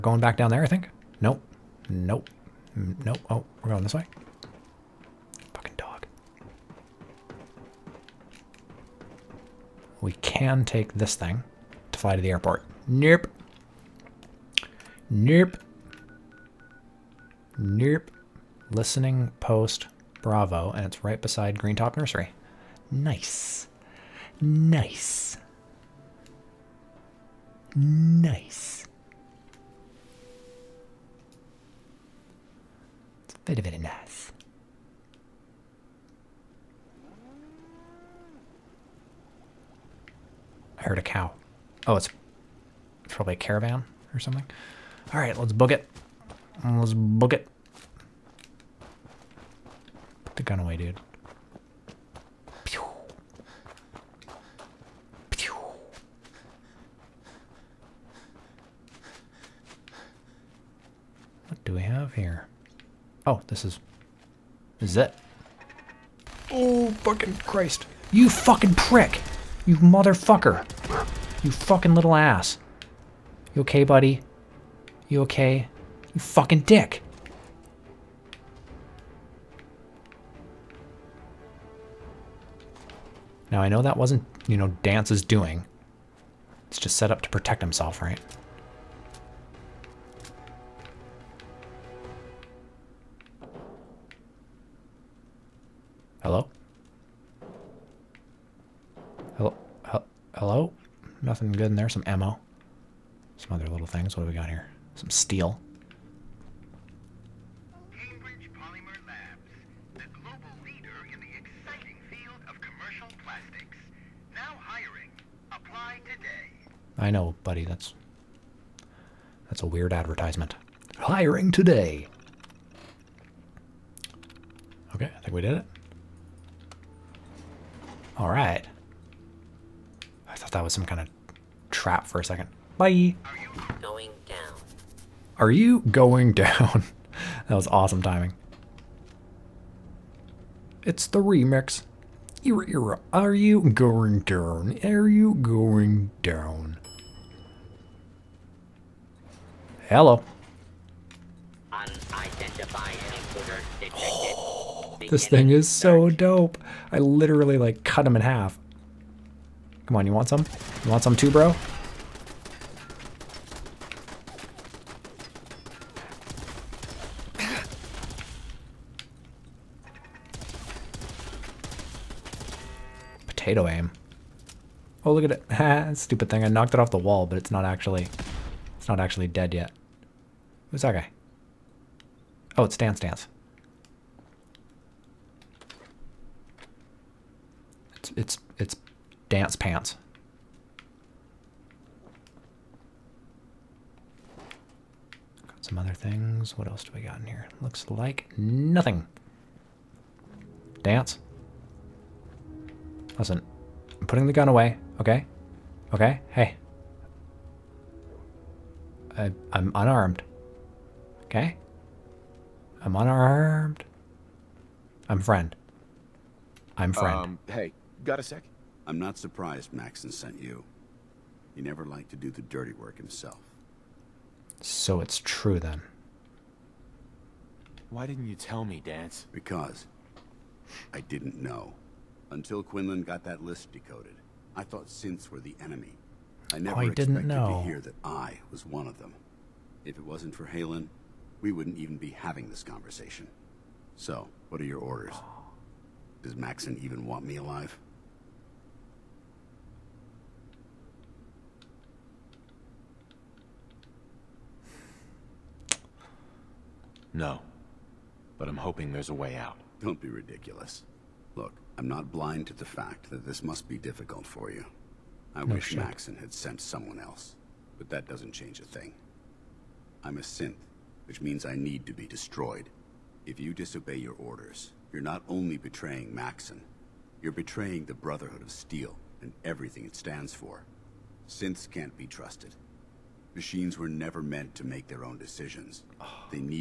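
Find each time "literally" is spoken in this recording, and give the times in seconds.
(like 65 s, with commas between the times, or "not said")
156 s.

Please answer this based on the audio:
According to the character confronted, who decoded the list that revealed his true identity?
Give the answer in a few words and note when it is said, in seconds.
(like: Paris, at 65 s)
Quinlan, at 232 s.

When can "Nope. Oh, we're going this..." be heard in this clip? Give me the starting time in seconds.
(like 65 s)
3 s.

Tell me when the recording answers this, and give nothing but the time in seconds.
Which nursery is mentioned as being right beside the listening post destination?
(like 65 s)
21 s.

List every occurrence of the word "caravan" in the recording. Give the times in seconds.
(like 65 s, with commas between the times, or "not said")
43 s.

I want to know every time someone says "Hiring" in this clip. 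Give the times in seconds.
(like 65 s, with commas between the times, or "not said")
120 s.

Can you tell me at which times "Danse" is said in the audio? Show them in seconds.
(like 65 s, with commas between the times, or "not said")
84 s, 200 s, 228 s.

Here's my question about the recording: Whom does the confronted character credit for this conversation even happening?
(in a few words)
Haylen.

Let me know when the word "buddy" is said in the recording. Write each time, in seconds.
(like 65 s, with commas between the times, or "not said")
73 s, 117 s.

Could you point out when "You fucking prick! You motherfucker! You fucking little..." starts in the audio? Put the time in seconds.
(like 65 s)
68 s.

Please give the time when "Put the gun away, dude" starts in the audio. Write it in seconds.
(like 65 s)
50 s.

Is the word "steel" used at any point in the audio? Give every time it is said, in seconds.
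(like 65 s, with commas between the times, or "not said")
105 s, 278 s.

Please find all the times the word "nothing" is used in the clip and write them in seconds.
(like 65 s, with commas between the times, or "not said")
101 s, 198 s.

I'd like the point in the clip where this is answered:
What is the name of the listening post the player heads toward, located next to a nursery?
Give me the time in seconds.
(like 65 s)
18 s.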